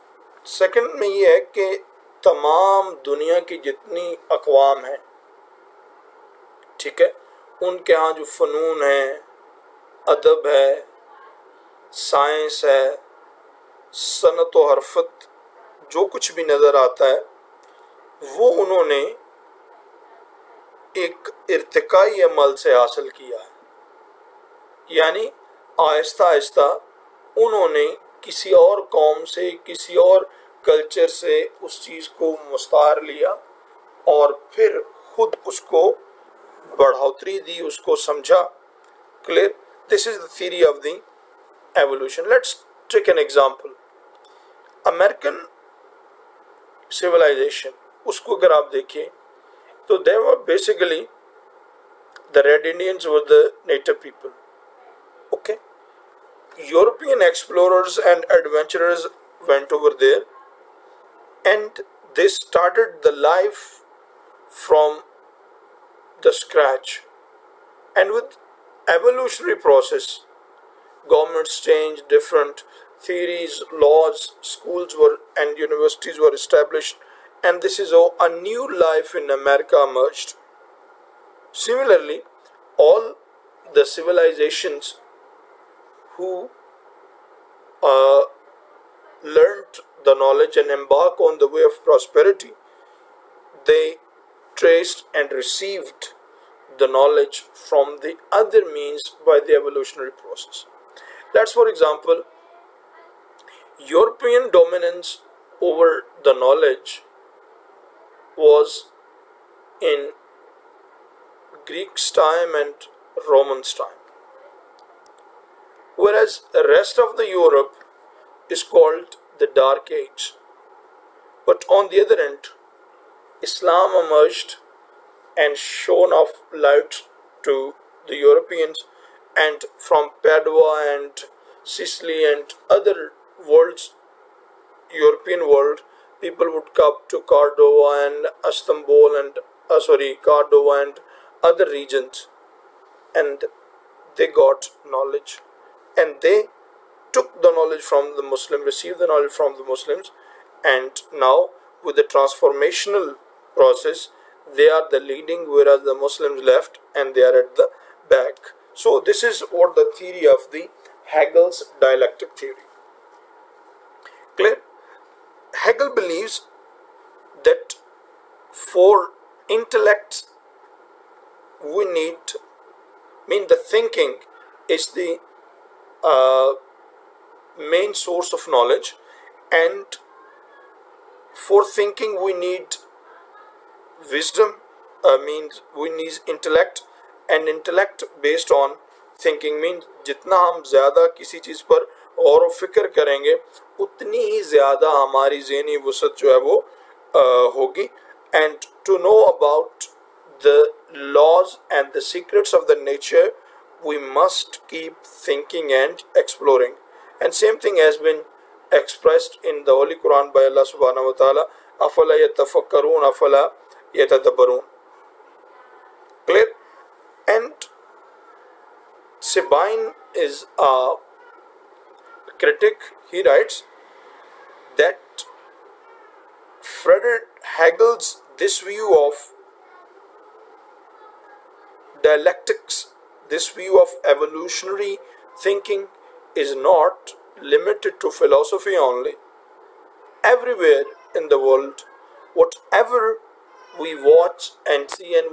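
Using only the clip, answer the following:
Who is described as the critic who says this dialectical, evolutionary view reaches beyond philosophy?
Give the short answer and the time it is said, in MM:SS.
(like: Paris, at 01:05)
Sabine, at 03:39.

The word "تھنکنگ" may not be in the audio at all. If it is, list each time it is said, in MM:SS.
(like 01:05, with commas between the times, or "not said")
03:01, 03:09.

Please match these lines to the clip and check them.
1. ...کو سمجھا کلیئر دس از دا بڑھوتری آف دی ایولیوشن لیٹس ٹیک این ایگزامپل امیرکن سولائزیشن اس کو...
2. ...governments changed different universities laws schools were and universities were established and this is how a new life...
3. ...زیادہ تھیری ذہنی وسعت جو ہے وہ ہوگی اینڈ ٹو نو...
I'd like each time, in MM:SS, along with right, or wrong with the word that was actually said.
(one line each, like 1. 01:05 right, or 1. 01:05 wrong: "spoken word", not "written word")
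1. 00:37 wrong: "تھیری", not "بڑھوتری"
2. 01:11 wrong: "theories", not "universities"
3. 03:14 wrong: "ہماری", not "تھیری".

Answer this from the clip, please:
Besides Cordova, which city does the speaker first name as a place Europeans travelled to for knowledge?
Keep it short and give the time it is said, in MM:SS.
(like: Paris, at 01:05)
Istanbul, at 02:18.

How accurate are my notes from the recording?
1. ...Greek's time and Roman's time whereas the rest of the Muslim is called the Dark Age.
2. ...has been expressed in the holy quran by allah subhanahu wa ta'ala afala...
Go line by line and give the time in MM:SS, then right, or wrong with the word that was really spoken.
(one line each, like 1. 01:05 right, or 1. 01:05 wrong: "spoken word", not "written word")
1. 01:51 wrong: "Europe", not "Muslim"
2. 03:27 right.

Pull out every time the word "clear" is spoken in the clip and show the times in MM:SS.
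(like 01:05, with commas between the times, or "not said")
02:44, 03:36.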